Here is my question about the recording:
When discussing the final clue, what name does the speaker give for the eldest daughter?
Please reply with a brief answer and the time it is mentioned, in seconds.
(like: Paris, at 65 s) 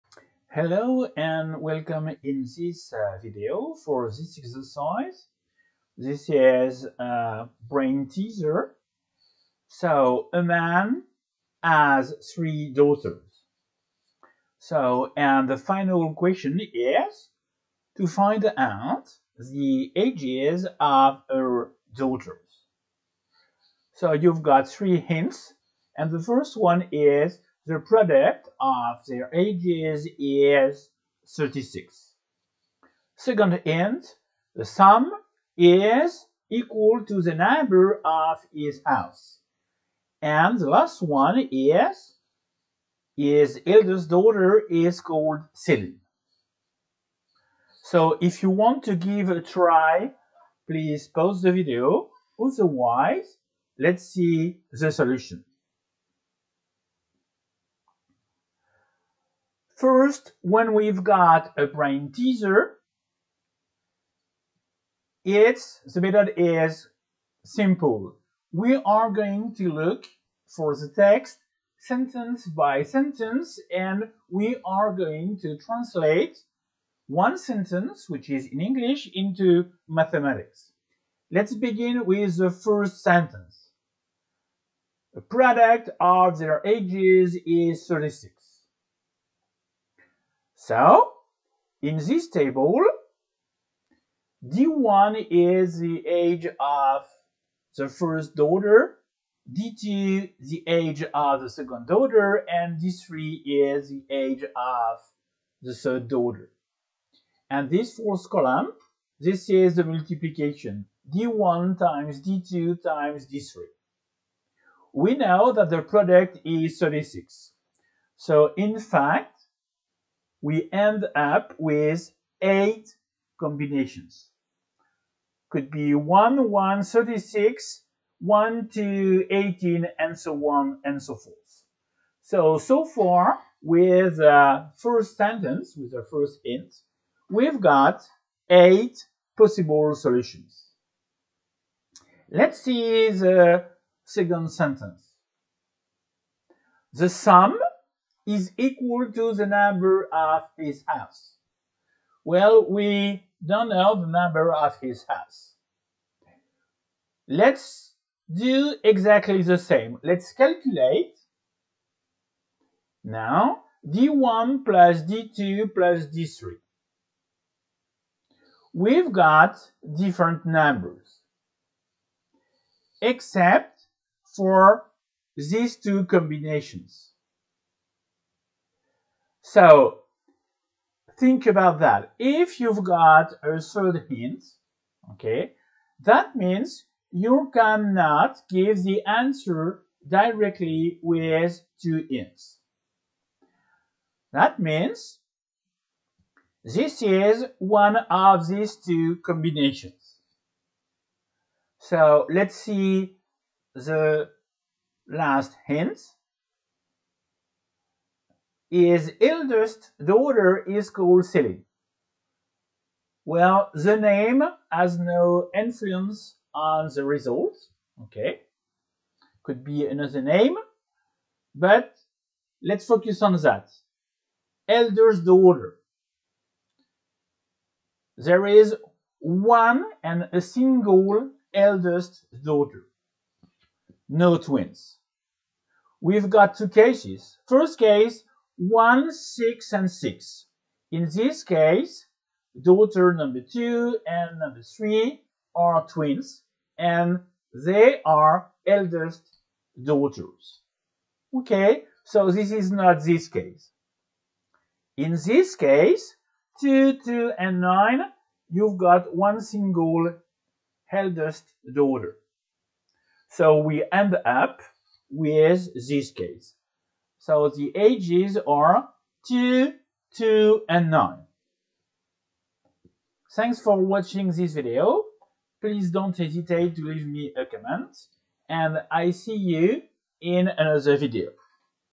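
Celine, at 211 s.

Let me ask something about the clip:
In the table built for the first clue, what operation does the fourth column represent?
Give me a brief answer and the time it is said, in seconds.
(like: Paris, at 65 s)
Multiplication, at 109 s.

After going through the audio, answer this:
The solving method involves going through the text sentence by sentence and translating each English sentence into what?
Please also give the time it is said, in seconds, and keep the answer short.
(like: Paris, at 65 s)
Mathematics, at 79 s.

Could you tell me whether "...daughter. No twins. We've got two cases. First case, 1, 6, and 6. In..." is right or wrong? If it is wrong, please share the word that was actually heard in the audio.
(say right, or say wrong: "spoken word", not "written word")
right.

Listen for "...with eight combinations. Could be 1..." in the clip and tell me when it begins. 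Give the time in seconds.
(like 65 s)
121 s.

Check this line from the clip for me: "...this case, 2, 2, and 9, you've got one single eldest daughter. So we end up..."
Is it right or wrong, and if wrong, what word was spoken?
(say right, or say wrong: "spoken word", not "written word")
right.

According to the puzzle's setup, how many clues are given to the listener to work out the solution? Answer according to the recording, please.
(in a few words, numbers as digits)
3.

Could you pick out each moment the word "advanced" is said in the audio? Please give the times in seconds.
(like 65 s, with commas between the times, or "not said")
not said.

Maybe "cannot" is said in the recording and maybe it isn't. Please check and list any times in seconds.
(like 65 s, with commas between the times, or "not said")
187 s.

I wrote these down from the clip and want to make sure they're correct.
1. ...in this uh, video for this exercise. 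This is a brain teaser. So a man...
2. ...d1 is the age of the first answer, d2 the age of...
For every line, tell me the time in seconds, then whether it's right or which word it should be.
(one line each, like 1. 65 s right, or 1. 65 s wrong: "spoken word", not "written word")
1. 2 s right
2. 94 s wrong: "daughter", not "answer".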